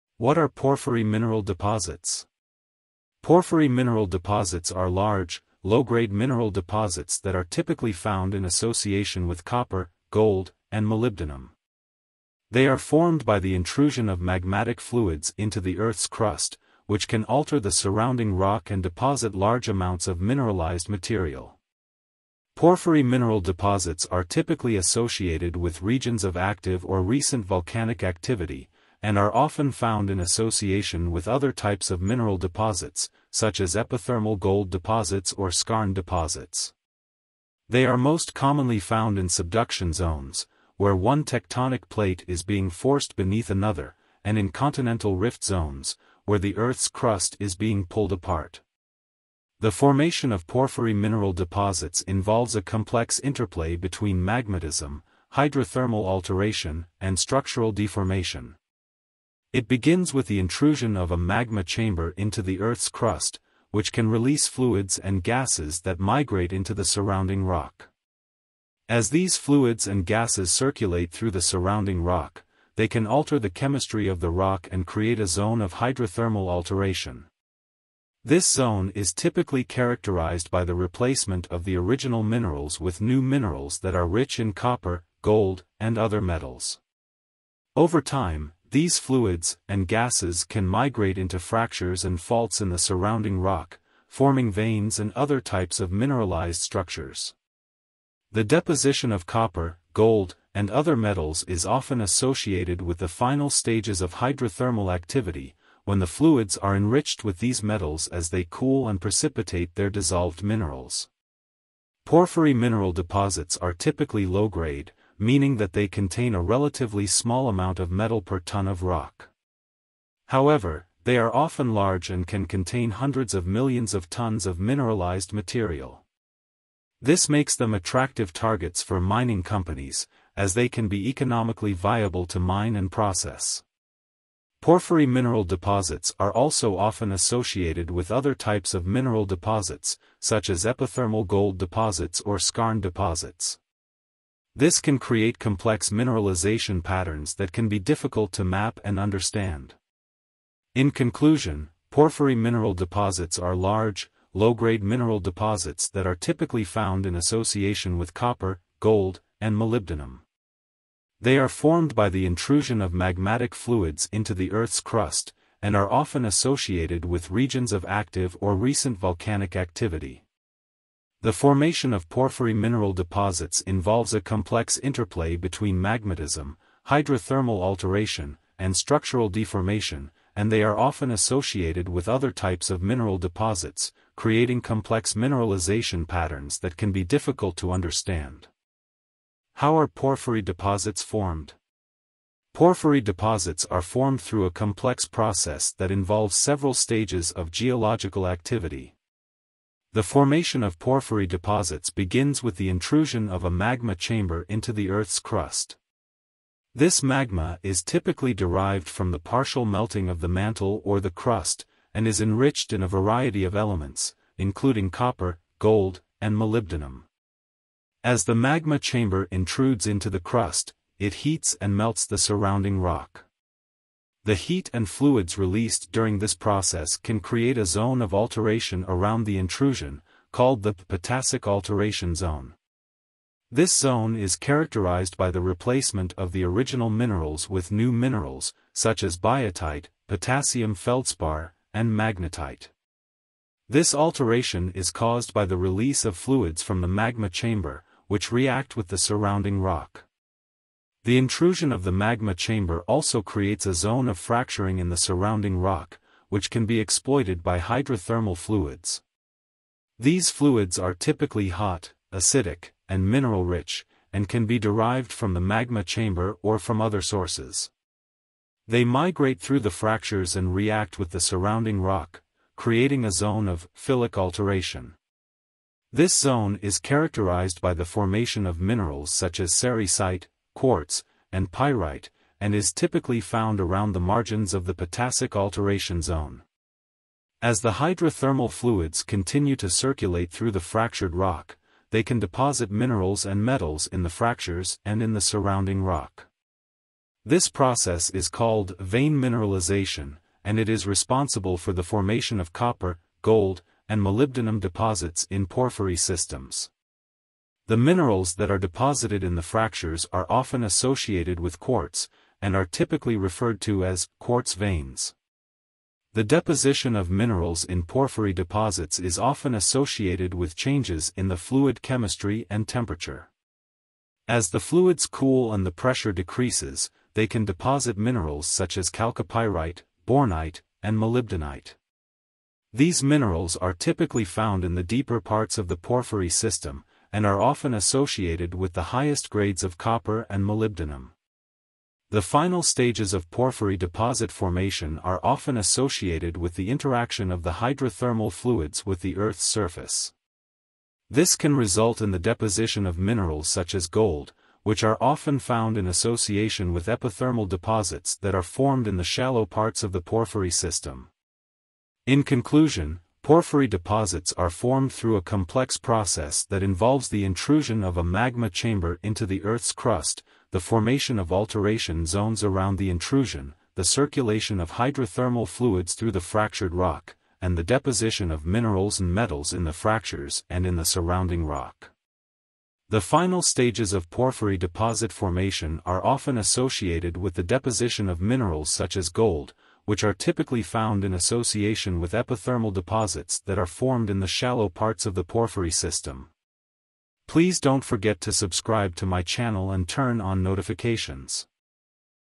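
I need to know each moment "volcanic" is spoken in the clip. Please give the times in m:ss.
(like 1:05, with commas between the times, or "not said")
0:27, 2:48.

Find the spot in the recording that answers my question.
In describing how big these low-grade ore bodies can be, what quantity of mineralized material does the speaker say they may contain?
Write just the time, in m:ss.
2:02.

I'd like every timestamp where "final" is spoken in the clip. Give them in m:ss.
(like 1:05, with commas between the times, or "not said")
1:43, 5:42, 6:23.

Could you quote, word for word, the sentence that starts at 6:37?
Please don't forget to subscribe to my channel and turn on notifications.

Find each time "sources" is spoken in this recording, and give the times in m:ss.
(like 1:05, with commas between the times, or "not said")
4:27.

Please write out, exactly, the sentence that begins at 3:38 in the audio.
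As the magma chamber intrudes into the crust, it heats and melts the surrounding rock.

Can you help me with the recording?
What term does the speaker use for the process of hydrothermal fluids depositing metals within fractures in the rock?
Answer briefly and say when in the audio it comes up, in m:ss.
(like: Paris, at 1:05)
vein mineralization, at 4:58.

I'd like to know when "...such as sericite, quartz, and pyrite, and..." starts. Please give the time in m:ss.
4:39.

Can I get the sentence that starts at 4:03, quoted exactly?
This alteration is caused by the release of fluids from the magma chamber, which react with the surrounding rock.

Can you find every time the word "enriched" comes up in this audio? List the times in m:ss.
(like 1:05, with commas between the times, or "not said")
1:46, 3:32.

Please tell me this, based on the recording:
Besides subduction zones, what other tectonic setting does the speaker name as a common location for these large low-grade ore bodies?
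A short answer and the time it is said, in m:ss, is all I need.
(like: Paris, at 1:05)
continental rift zones, at 0:44.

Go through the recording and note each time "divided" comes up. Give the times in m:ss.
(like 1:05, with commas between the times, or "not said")
not said.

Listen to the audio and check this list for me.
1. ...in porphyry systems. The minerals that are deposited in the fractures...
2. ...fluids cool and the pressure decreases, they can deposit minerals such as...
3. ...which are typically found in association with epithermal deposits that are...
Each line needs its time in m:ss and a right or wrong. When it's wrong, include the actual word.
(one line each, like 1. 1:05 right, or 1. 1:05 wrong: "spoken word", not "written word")
1. 5:05 right
2. 5:24 right
3. 6:29 right.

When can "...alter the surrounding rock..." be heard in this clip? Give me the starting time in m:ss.
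0:17.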